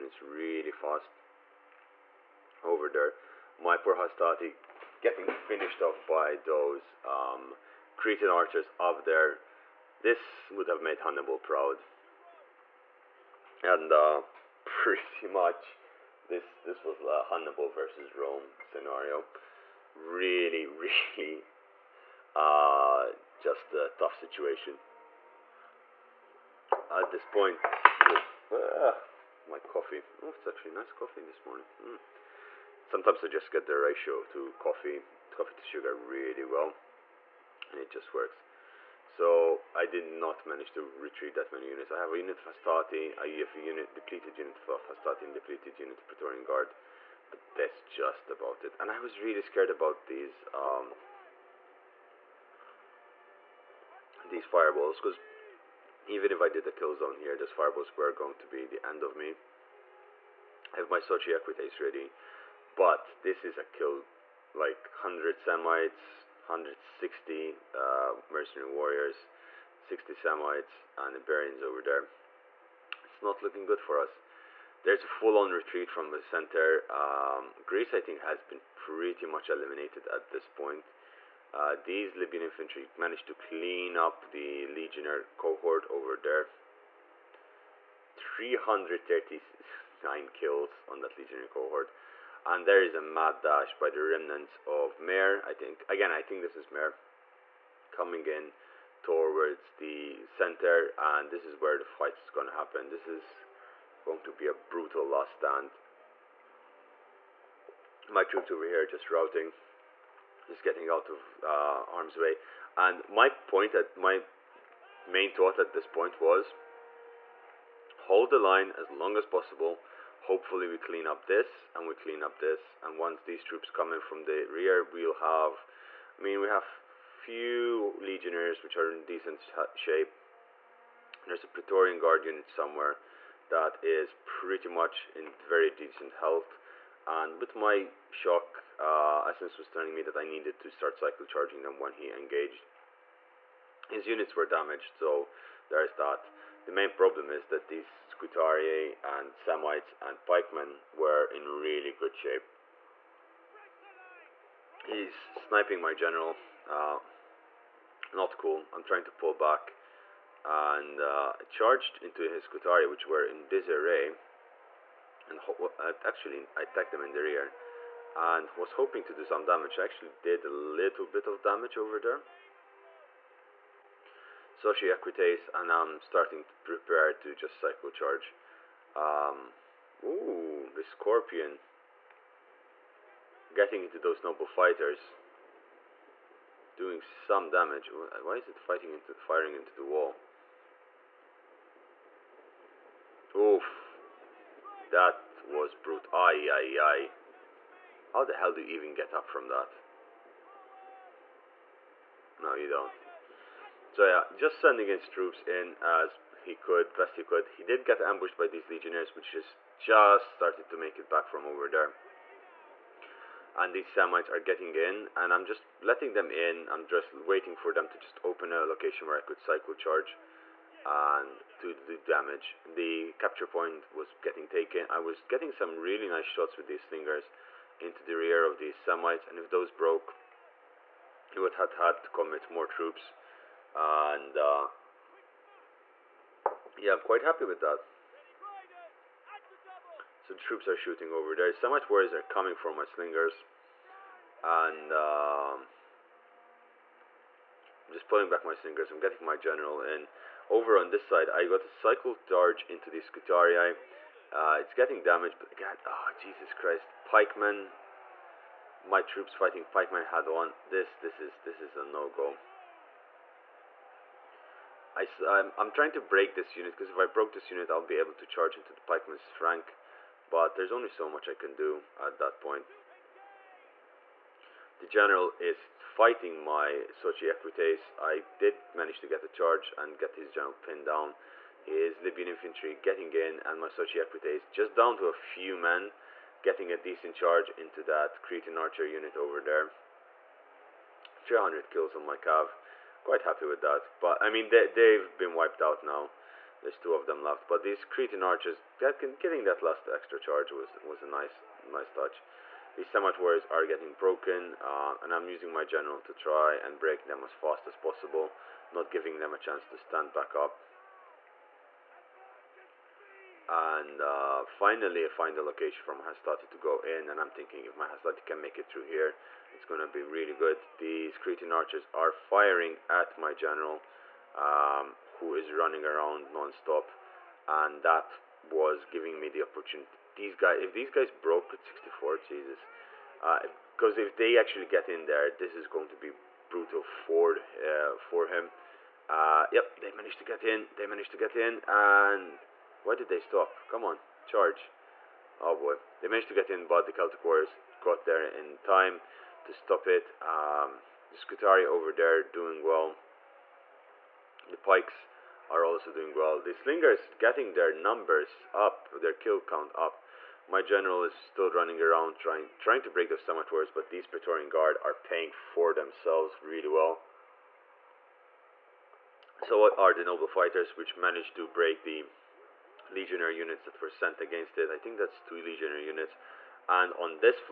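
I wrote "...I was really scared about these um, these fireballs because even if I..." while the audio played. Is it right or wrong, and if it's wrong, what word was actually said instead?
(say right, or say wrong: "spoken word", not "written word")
right.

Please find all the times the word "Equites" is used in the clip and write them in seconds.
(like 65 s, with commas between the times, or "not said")
61 s, 277 s, 284 s.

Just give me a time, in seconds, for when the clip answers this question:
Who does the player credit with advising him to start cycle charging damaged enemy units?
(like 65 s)
139 s.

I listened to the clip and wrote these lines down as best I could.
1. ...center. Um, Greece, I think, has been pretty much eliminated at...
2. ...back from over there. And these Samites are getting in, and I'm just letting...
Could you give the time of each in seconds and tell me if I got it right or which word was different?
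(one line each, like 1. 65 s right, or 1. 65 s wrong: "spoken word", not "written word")
1. 76 s right
2. 211 s right.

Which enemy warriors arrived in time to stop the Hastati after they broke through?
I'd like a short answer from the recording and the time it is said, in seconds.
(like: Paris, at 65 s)
Celtic Warriors, at 346 s.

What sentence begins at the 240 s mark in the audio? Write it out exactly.
So troops are shooting over there.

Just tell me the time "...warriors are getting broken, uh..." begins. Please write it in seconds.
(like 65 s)
303 s.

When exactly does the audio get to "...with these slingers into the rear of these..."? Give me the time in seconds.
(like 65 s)
226 s.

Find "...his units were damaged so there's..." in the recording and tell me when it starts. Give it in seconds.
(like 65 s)
143 s.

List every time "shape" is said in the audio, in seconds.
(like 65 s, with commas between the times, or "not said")
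129 s, 152 s.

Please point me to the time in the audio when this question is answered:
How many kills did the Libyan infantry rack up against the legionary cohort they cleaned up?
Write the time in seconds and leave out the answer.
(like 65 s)
88 s.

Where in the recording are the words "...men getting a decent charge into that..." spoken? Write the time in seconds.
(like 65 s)
285 s.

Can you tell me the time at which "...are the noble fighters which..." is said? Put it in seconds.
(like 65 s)
369 s.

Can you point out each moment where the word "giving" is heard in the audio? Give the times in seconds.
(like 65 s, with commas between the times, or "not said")
308 s, 328 s.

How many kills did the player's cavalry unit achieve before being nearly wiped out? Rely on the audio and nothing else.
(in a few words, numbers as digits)
300.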